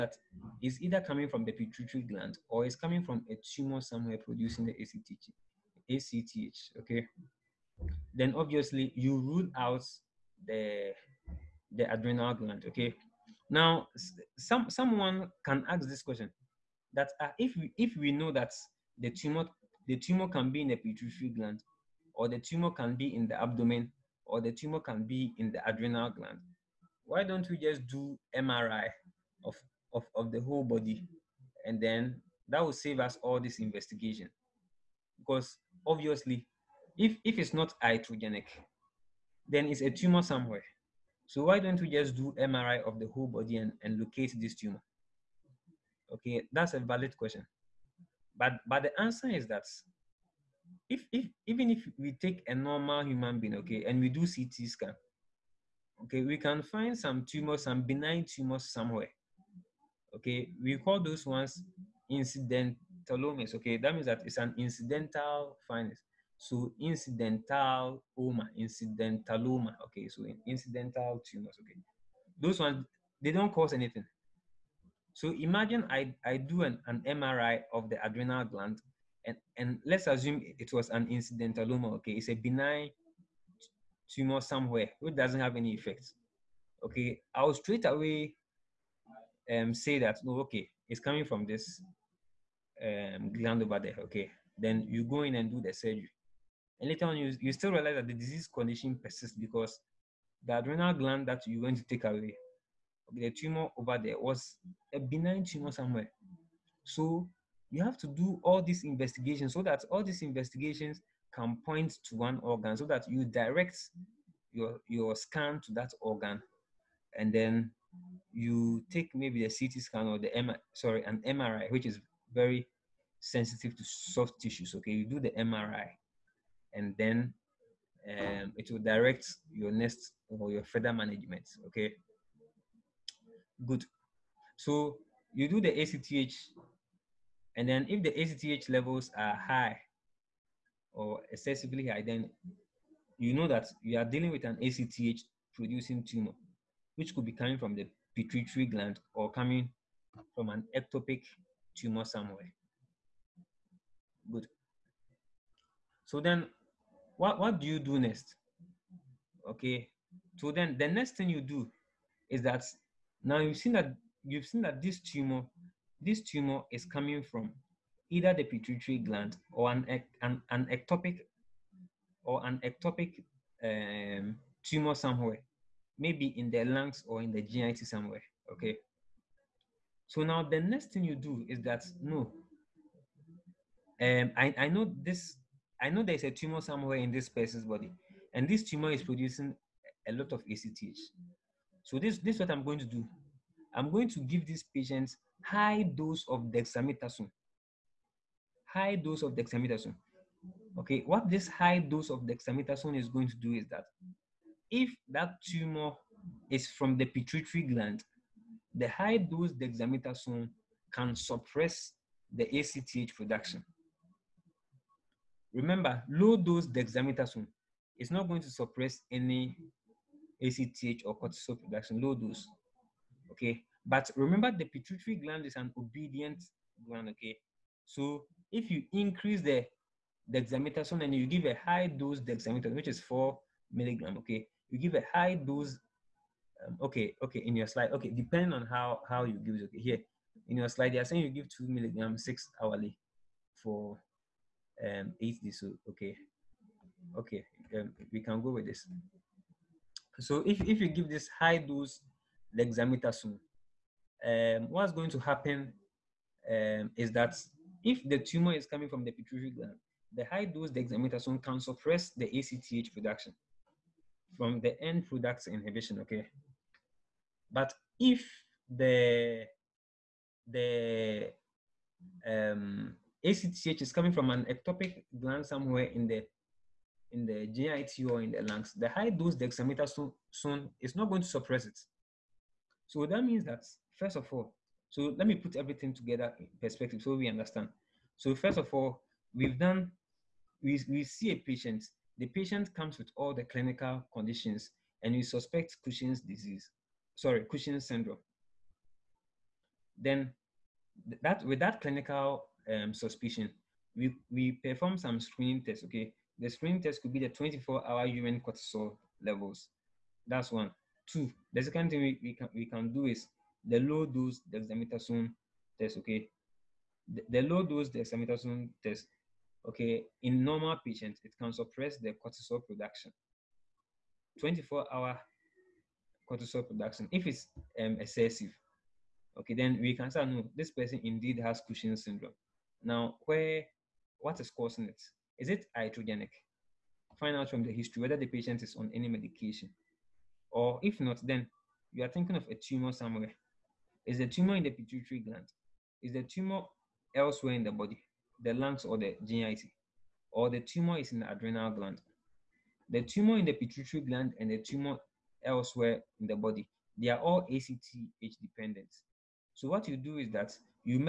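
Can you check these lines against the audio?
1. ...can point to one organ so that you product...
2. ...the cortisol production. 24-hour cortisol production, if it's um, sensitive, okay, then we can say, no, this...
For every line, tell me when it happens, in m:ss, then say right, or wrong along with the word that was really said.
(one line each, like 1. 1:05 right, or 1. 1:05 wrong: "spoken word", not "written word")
1. 1:51 wrong: "direct", not "product"
2. 5:21 wrong: "excessive", not "sensitive".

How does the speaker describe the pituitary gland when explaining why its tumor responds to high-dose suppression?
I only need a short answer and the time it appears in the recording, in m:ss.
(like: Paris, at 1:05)
obedient, at 3:45.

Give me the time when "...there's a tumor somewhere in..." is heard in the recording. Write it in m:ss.
3:06.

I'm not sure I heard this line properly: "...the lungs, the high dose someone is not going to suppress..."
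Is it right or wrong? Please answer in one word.
wrong.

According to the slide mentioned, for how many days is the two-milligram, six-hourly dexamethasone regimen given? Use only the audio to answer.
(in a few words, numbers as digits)
8 days.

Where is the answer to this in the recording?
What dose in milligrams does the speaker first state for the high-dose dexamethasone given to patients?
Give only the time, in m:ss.
3:52.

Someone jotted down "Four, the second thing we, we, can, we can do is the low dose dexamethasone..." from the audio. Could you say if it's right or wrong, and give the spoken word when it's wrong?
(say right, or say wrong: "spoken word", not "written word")
wrong: "Two", not "Four".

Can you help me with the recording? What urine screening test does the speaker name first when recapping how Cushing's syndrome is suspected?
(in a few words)
24-hour urine cortisol.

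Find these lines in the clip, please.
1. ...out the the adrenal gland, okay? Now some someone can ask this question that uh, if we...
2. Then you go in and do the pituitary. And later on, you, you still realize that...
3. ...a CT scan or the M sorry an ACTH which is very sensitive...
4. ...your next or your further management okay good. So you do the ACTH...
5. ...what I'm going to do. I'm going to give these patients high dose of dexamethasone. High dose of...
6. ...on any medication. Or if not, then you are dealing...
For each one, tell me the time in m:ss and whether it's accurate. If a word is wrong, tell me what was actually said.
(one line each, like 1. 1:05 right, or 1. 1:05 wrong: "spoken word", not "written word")
1. 0:09 right
2. 1:34 wrong: "surgery", not "pituitary"
3. 1:59 wrong: "MRI", not "ACTH"
4. 2:09 right
5. 3:12 right
6. 5:38 wrong: "thinking", not "dealing".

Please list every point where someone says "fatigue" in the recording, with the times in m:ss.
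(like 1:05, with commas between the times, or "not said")
not said.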